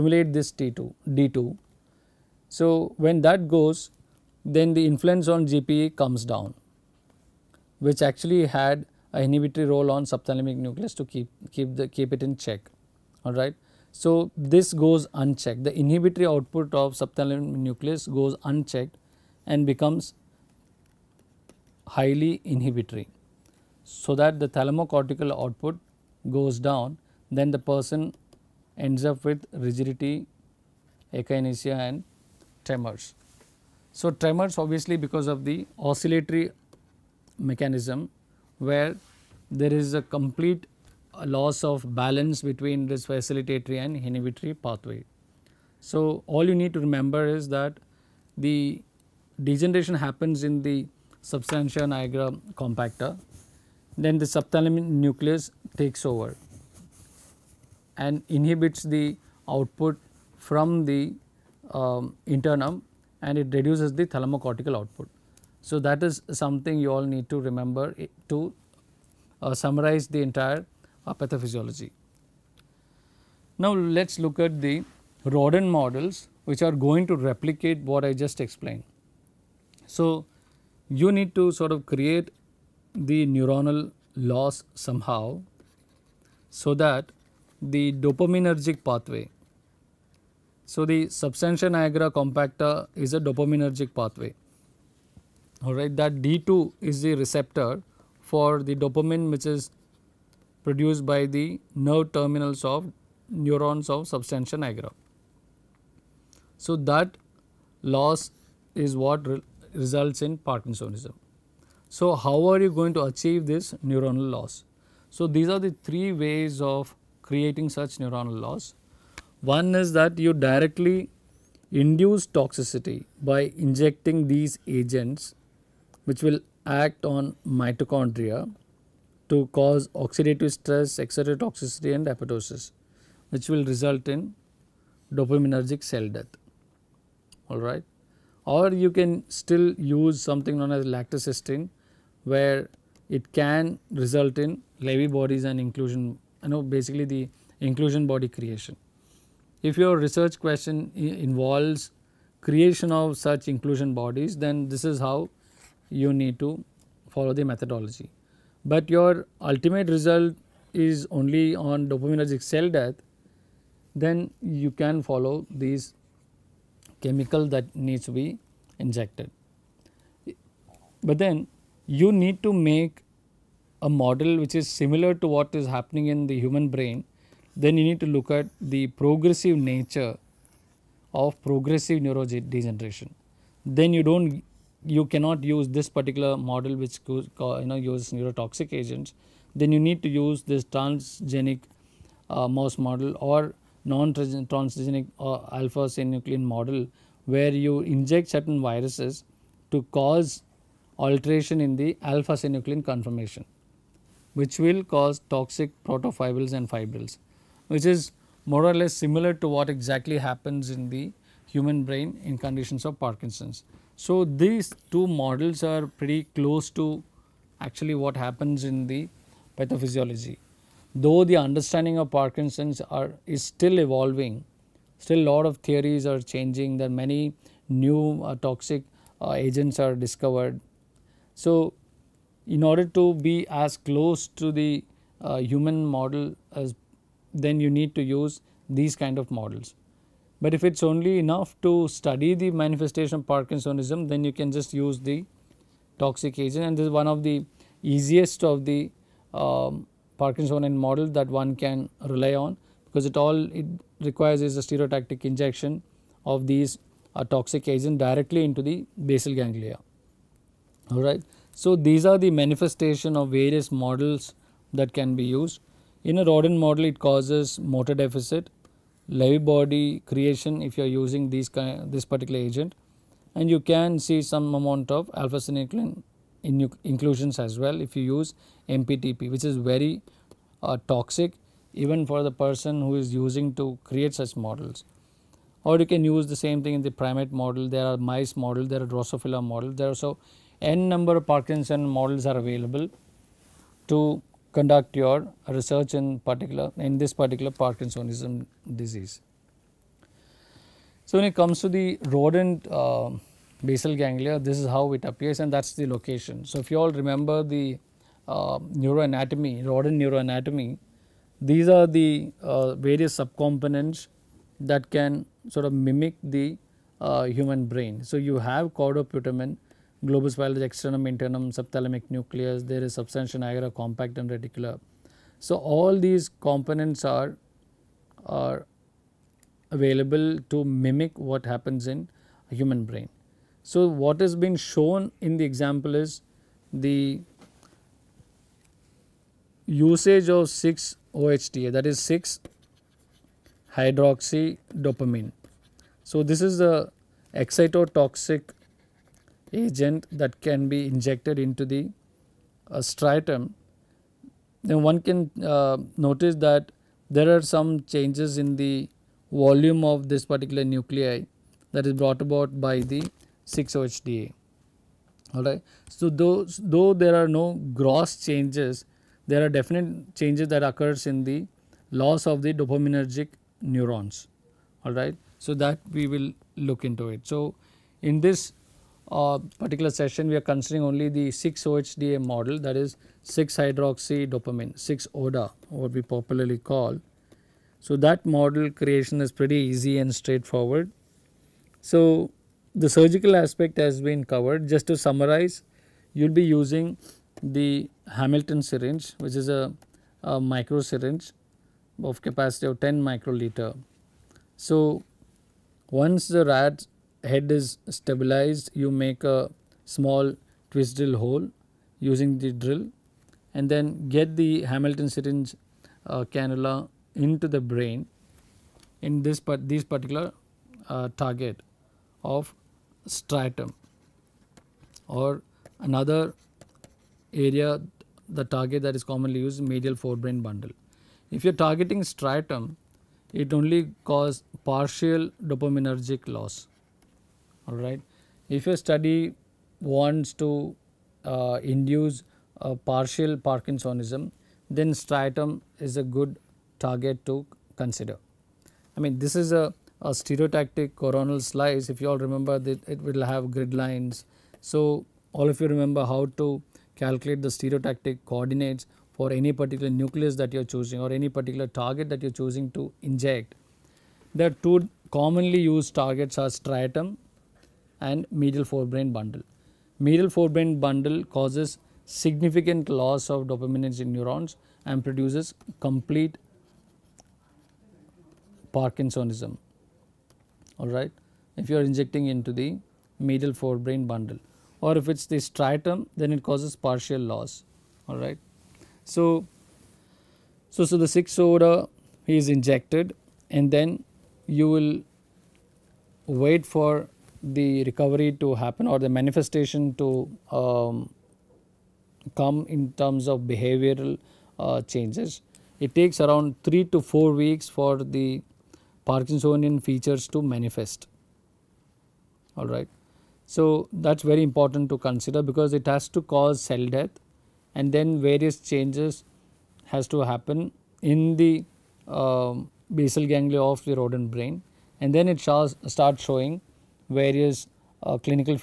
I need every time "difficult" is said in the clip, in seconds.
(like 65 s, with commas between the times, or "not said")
not said.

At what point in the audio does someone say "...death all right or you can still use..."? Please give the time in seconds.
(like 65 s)
136 s.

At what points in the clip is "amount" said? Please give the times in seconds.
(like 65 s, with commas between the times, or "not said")
274 s.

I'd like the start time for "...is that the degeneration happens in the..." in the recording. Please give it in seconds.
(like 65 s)
47 s.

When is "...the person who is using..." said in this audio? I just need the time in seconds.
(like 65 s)
282 s.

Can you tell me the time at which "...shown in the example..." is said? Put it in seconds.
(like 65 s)
334 s.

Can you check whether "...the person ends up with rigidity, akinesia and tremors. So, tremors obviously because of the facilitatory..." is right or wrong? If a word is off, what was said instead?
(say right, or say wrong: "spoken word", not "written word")
wrong: "oscillatory", not "facilitatory".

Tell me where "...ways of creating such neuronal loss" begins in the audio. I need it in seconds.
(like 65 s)
116 s.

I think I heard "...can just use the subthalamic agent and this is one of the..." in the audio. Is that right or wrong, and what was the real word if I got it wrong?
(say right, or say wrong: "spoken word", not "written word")
wrong: "toxic", not "subthalamic".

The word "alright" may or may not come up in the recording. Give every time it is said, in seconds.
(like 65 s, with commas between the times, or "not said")
13 s, 95 s, 365 s, 374 s.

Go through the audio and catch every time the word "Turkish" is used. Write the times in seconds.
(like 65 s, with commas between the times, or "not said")
not said.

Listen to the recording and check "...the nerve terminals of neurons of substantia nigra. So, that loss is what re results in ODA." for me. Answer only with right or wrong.
wrong.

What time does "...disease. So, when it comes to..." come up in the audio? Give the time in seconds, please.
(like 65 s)
298 s.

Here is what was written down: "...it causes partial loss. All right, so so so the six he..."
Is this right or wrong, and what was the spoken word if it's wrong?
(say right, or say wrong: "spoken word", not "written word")
right.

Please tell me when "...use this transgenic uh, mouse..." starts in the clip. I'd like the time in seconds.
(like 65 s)
190 s.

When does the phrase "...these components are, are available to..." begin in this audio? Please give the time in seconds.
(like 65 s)
325 s.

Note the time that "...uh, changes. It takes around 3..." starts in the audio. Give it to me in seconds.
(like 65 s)
504 s.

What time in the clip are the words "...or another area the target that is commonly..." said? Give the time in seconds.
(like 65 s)
425 s.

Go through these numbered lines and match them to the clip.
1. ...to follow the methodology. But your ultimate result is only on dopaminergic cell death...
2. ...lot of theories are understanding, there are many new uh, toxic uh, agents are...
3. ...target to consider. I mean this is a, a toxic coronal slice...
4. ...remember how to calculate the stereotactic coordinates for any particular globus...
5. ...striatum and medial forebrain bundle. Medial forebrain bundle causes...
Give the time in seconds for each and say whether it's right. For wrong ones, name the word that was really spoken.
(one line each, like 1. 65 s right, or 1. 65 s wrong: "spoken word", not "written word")
1. 156 s right
2. 225 s wrong: "changing", not "understanding"
3. 446 s wrong: "stereotactic", not "toxic"
4. 455 s wrong: "nucleus", not "globus"
5. 466 s right.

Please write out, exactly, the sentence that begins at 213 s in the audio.
So, these two models are pretty close to actually what happens in the pathophysiology.